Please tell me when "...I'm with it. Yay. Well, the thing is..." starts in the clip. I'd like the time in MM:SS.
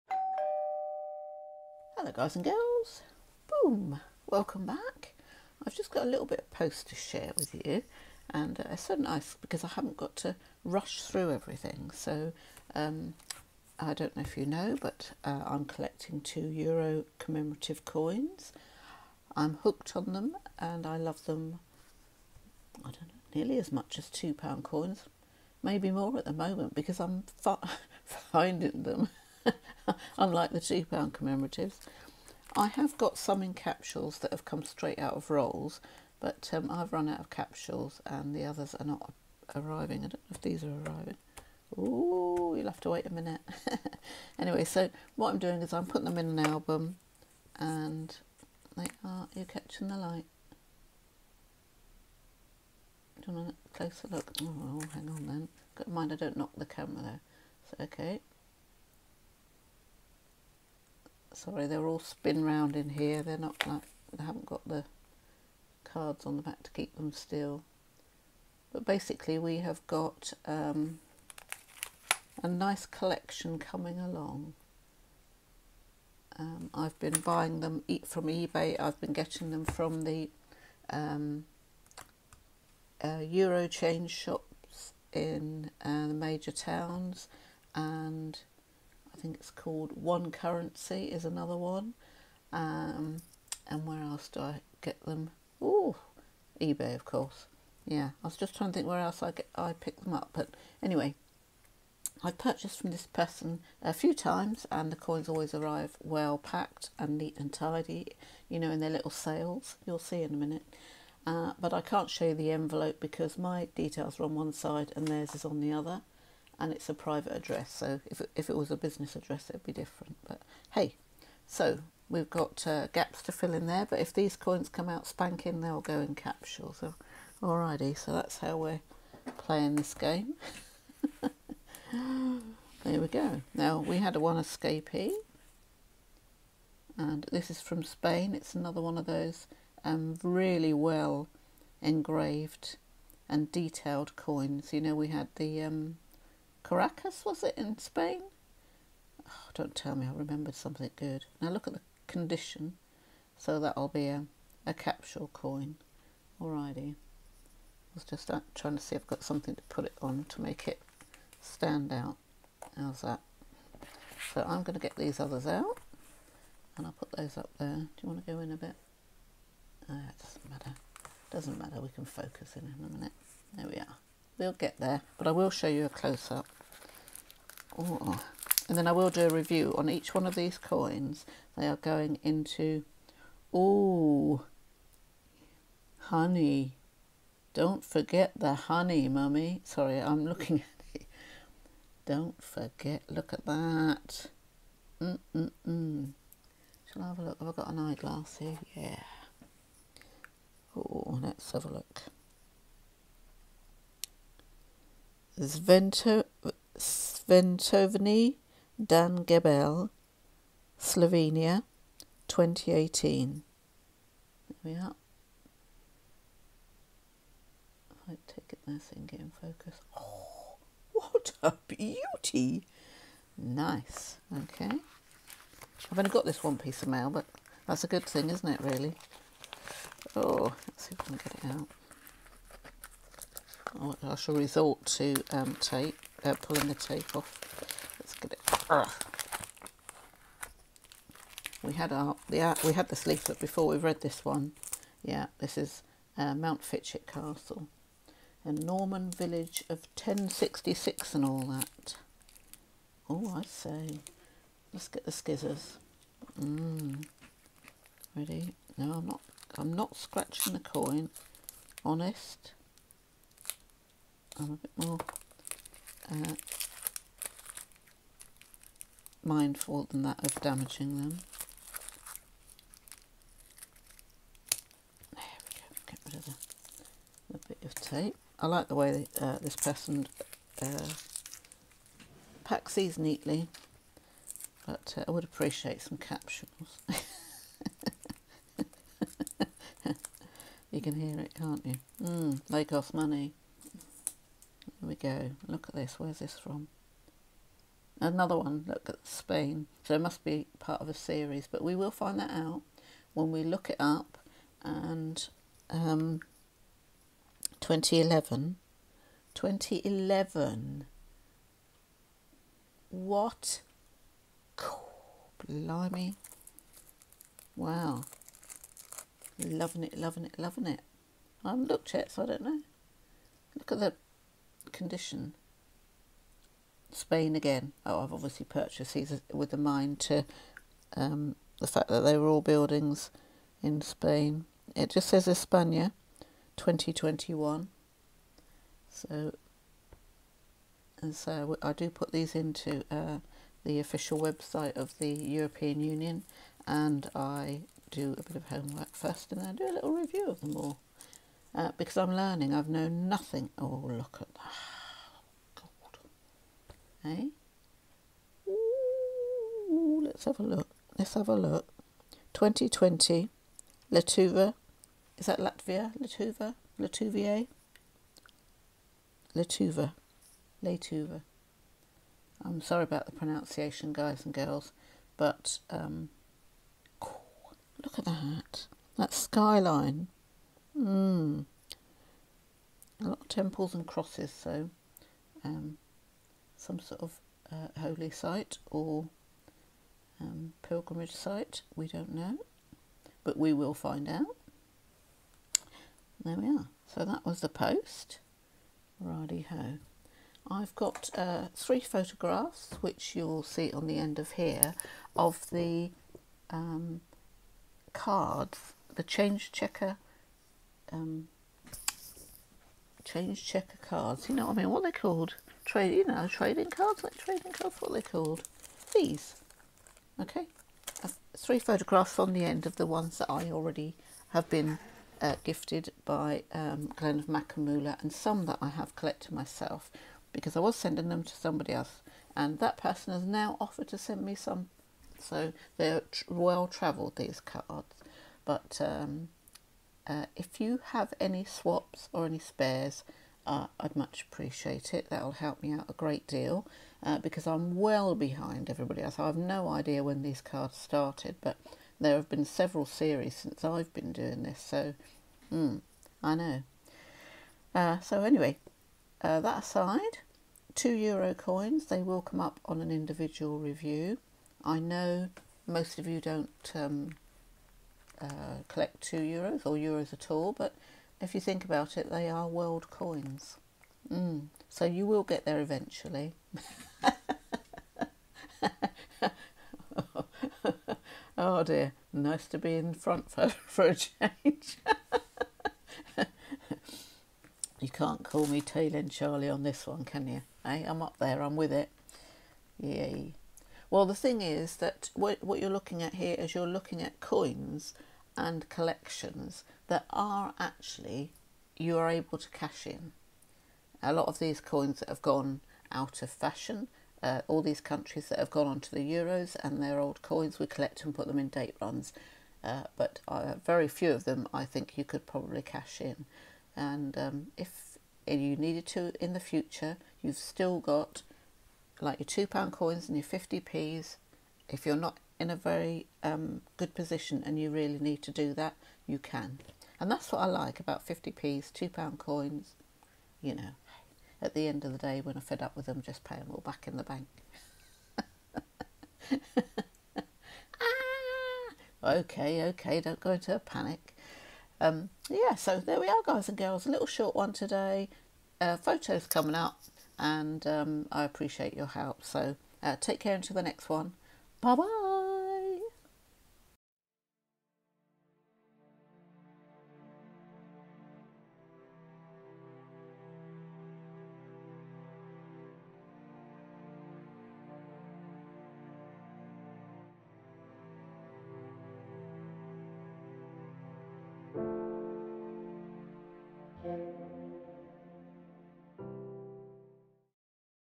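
08:11.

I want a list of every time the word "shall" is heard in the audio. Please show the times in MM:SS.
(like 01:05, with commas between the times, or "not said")
03:16, 03:54.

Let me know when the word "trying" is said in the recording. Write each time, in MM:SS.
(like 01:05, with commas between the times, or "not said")
01:38, 02:38.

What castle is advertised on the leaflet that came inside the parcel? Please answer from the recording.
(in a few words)
Mountfitchet Castle.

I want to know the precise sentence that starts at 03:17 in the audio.
Have I got an eyeglass here?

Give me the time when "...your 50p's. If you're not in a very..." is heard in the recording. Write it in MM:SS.
08:43.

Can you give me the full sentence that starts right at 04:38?
I like the way uh, this person uh, packs these neatly, but uh, I would appreciate some capsules.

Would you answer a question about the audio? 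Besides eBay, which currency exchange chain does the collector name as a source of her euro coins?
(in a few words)
One Currency.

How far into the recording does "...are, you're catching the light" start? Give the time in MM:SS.
00:49.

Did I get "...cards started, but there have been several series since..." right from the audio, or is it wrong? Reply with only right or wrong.
right.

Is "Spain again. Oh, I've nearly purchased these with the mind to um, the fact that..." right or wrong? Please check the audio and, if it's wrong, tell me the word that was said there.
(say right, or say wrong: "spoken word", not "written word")
wrong: "obviously", not "nearly".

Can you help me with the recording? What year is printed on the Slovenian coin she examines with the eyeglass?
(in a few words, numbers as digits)
2018.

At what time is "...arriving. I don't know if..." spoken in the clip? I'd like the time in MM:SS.
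00:39.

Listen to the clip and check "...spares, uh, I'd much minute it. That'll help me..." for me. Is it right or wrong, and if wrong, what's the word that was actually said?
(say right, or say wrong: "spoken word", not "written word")
wrong: "appreciate", not "minute".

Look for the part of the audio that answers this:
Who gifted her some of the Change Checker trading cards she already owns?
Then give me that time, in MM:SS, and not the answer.
07:06.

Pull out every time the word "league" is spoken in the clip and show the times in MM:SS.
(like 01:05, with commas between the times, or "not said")
not said.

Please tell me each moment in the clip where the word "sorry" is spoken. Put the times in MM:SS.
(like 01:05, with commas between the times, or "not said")
01:01, 03:09, 06:12.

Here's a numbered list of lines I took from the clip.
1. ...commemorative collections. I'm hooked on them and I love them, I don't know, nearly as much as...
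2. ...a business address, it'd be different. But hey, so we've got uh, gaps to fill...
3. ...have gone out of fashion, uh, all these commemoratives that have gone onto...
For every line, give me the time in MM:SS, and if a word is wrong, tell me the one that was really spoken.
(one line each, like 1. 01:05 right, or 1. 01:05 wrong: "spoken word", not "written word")
1. 00:17 wrong: "coins", not "collections"
2. 01:58 right
3. 08:25 wrong: "countries", not "commemoratives".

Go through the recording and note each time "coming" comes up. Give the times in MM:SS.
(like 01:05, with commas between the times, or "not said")
01:13, 09:09.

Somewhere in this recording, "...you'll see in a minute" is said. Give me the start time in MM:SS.
01:49.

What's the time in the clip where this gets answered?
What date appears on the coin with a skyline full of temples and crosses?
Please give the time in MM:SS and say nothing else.
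06:02.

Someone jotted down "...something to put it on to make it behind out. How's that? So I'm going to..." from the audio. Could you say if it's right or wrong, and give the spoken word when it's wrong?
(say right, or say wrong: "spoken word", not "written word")
wrong: "stand", not "behind".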